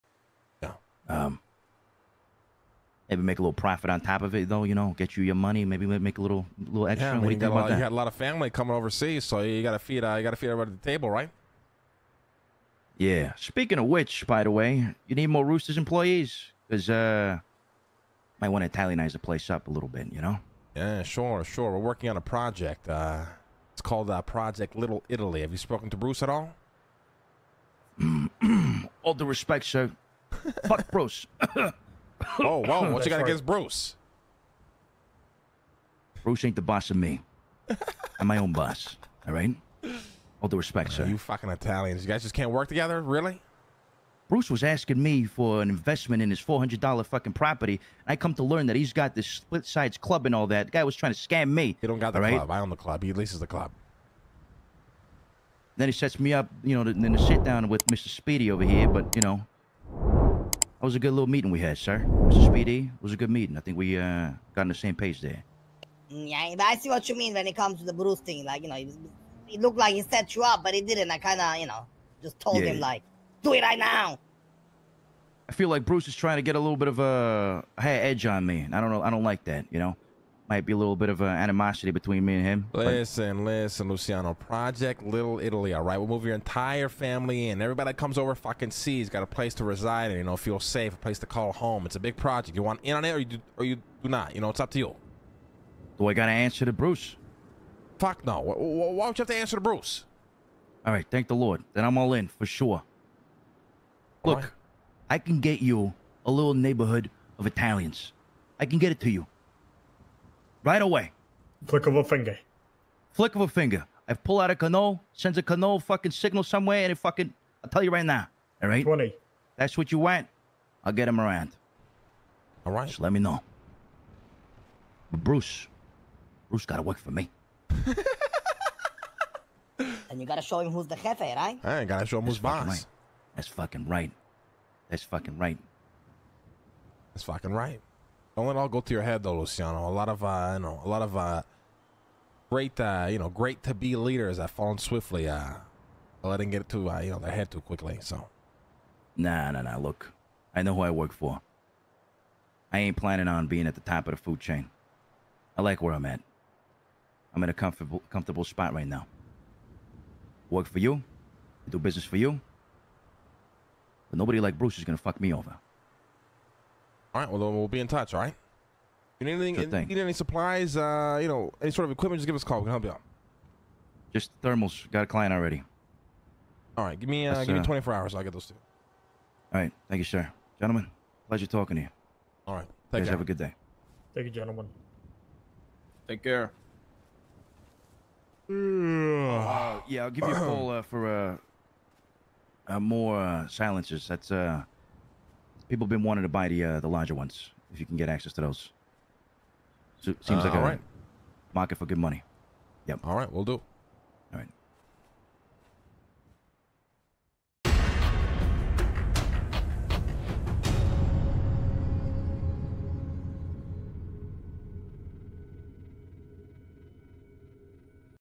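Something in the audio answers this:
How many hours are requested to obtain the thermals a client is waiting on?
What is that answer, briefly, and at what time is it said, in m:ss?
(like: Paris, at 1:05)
24, at 2:57.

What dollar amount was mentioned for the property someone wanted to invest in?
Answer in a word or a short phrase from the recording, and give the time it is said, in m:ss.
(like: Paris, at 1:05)
$400, at 0:46.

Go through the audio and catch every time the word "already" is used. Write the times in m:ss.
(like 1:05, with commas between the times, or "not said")
2:55.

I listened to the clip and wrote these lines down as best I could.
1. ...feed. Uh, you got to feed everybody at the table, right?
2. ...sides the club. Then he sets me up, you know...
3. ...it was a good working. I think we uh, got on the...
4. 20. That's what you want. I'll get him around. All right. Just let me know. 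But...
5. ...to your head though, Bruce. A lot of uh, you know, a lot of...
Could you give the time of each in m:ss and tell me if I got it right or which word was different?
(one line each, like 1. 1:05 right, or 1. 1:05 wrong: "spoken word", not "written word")
1. 0:09 right
2. 0:53 wrong: "leases", not "sides"
3. 1:02 wrong: "meeting", not "working"
4. 1:58 right
5. 2:18 wrong: "Luciano", not "Bruce".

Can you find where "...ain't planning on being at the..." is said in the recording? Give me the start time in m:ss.
2:32.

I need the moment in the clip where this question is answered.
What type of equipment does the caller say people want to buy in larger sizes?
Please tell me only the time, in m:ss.
3:13.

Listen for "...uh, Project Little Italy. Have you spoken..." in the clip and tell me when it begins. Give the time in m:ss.
0:24.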